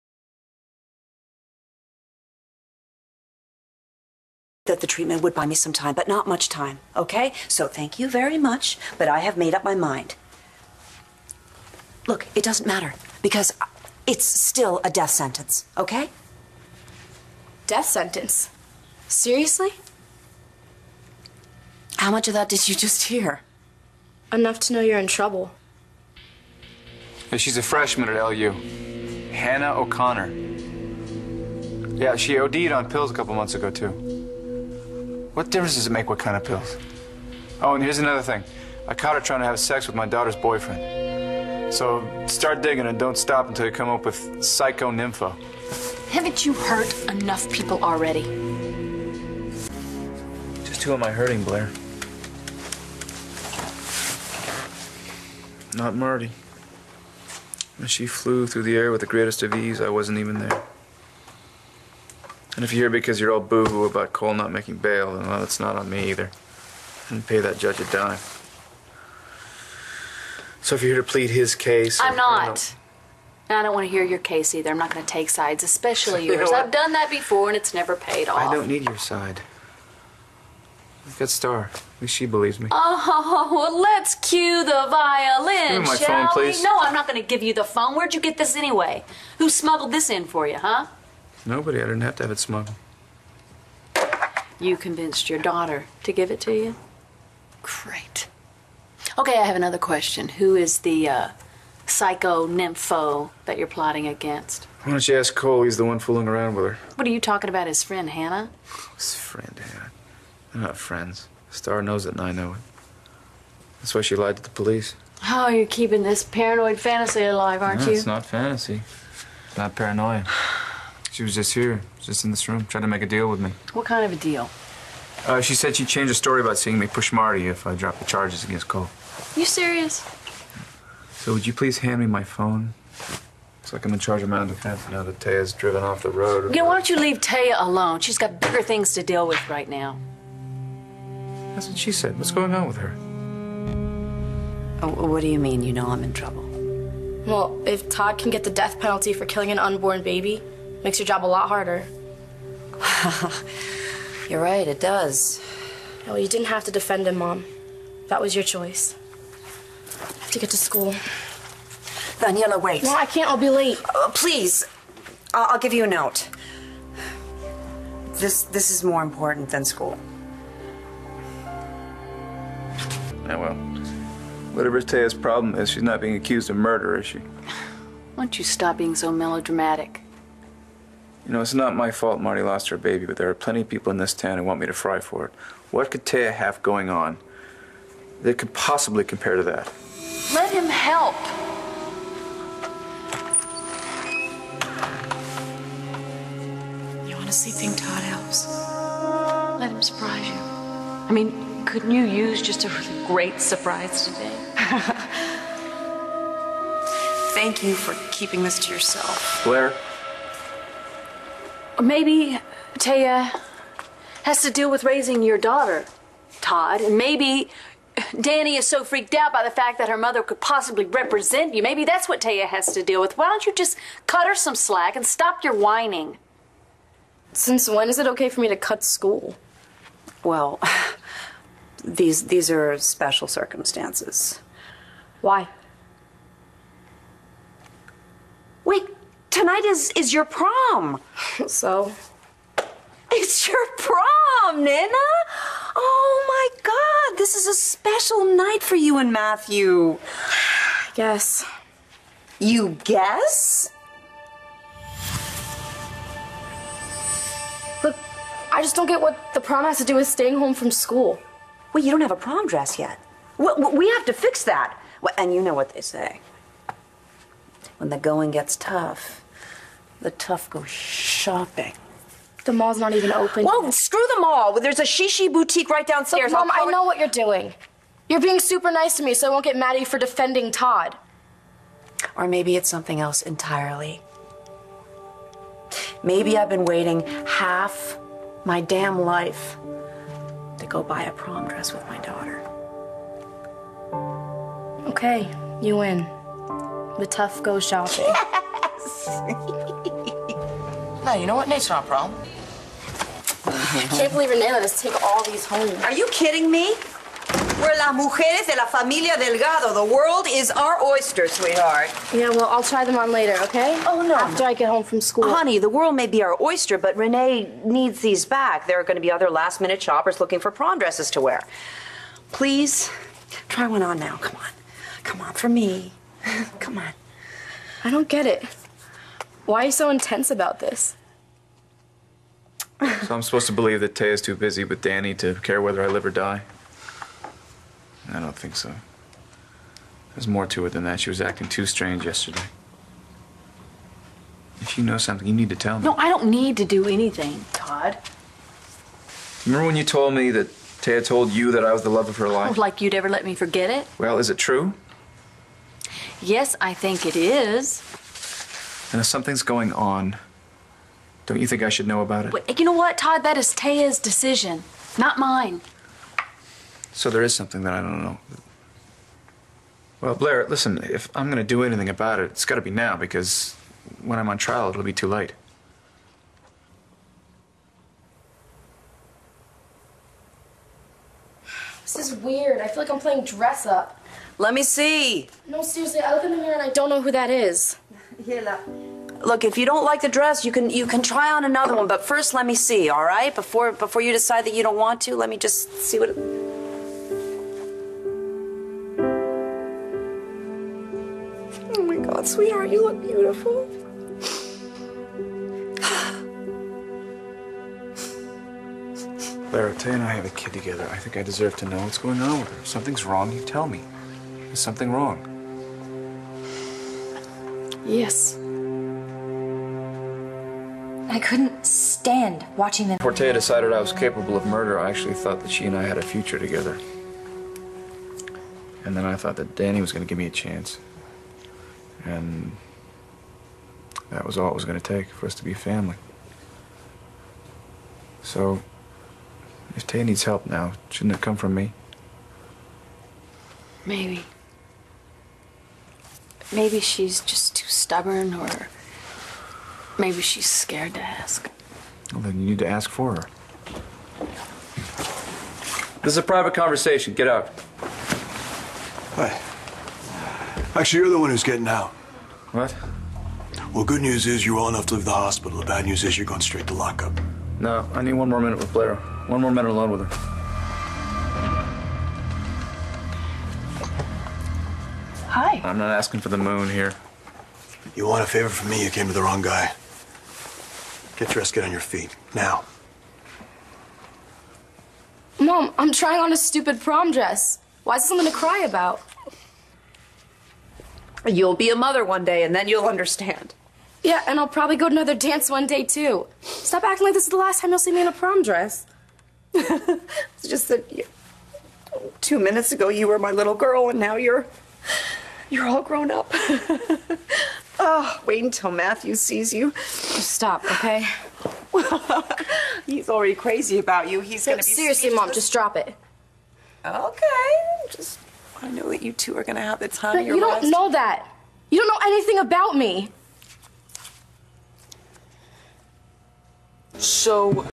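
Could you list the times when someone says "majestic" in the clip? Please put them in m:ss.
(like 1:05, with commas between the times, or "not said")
not said.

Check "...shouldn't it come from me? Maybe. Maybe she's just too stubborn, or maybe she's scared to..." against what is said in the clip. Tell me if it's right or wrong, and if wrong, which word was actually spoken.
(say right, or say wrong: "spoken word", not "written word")
right.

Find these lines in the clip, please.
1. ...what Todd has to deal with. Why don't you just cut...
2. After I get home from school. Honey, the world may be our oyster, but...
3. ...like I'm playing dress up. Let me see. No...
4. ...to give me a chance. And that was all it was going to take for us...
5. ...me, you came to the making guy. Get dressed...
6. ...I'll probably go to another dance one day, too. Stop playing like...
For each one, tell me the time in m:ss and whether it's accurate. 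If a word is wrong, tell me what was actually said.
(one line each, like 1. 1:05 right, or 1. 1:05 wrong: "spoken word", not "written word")
1. 3:42 wrong: "Téa", not "Todd"
2. 5:14 right
3. 6:22 right
4. 7:10 right
5. 7:58 wrong: "wrong", not "making"
6. 8:14 wrong: "acting", not "playing".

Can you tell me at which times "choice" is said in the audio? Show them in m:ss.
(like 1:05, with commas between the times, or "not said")
2:38.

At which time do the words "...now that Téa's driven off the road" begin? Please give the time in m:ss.
2:14.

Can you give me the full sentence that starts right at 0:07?
So thank you very much, but I have made up my mind.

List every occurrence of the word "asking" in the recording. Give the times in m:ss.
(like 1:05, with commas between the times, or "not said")
7:55.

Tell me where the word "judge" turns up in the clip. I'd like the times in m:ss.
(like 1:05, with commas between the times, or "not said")
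1:07.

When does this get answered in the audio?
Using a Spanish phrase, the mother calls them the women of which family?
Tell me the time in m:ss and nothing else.
5:09.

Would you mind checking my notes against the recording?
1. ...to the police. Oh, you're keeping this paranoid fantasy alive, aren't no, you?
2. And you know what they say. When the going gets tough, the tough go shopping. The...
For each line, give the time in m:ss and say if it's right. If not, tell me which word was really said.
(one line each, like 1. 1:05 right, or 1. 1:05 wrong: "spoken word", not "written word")
1. 1:54 right
2. 4:25 right.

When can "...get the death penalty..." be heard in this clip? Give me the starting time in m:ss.
2:28.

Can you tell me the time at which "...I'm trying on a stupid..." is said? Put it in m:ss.
8:05.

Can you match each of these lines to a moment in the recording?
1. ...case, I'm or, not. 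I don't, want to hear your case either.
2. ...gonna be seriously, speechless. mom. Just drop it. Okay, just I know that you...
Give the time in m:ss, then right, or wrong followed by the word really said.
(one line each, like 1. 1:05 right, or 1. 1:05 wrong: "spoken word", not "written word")
1. 1:11 right
2. 8:34 right.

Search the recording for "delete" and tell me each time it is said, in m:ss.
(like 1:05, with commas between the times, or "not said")
not said.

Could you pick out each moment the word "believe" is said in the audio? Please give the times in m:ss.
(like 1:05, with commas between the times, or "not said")
1:22, 5:04, 5:33.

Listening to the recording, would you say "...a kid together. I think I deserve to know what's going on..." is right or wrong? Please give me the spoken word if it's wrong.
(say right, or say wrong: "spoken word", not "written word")
right.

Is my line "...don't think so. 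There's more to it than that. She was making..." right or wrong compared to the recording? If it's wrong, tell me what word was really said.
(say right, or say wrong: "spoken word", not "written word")
wrong: "acting", not "making".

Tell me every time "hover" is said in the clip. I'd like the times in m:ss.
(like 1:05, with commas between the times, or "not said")
not said.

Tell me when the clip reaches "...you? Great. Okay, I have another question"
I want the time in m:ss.
1:36.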